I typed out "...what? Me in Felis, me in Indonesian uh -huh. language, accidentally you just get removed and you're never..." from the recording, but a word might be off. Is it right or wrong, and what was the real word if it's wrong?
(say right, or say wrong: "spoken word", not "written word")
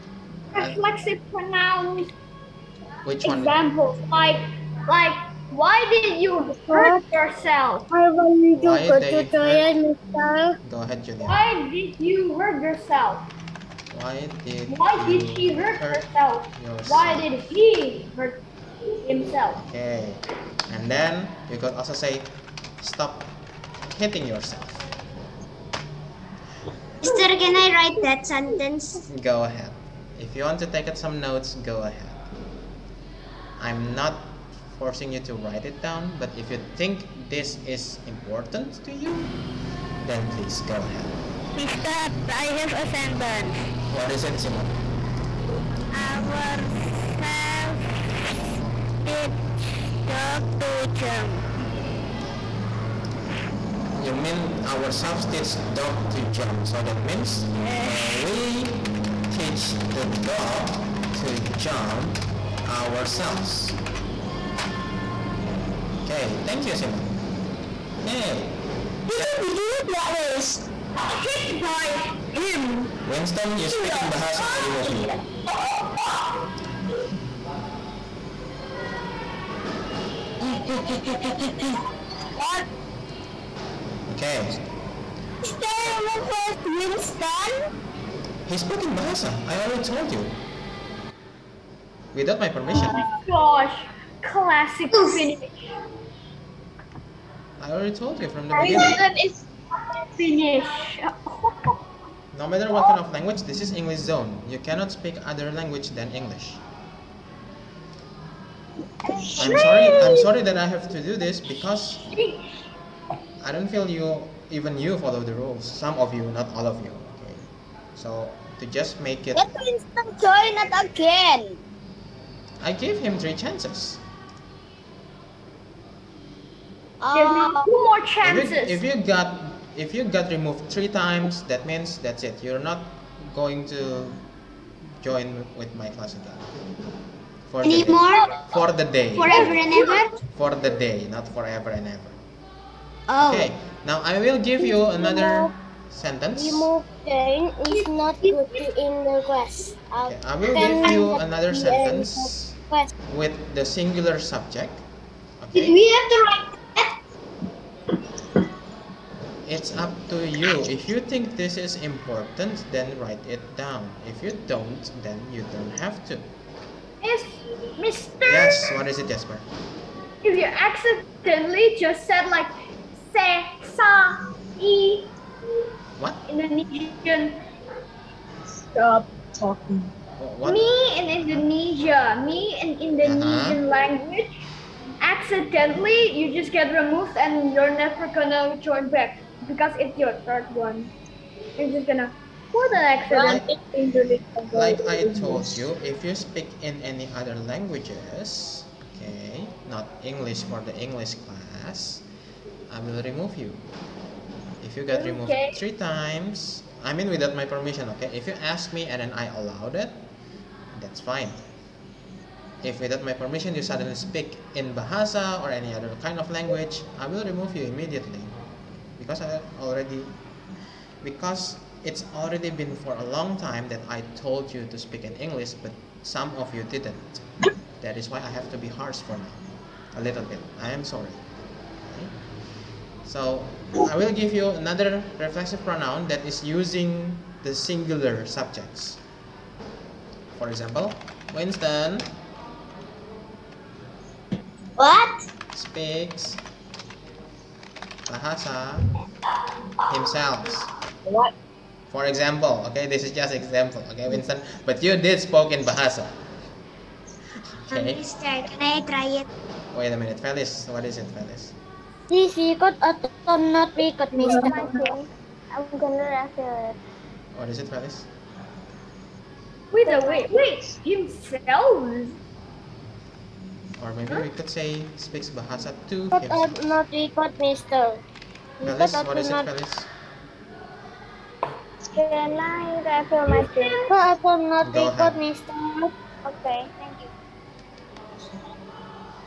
wrong: "Indonesia", not "Felis".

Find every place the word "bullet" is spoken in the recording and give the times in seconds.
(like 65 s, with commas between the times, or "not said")
not said.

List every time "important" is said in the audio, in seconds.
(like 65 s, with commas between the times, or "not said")
38 s, 161 s.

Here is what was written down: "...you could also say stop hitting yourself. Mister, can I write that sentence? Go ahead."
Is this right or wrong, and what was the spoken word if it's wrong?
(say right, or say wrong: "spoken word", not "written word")
right.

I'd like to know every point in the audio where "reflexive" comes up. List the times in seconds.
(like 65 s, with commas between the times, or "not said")
0 s, 235 s.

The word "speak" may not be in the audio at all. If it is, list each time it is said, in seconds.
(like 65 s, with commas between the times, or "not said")
73 s, 104 s, 196 s, 213 s, 224 s, 245 s, 274 s.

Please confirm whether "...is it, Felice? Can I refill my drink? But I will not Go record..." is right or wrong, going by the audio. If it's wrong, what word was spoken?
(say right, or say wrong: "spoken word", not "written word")
right.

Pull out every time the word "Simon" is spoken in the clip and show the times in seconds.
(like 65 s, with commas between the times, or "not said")
44 s, 66 s.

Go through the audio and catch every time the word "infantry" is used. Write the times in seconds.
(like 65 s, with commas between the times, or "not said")
not said.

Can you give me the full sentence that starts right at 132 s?
You're not going to join with my class again.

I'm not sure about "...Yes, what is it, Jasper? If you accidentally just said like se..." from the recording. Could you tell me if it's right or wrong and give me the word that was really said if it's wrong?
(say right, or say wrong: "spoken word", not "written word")
right.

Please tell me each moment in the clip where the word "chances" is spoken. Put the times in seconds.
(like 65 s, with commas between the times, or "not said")
123 s, 128 s.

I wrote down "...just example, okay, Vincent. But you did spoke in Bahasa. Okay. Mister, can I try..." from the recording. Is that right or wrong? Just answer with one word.
right.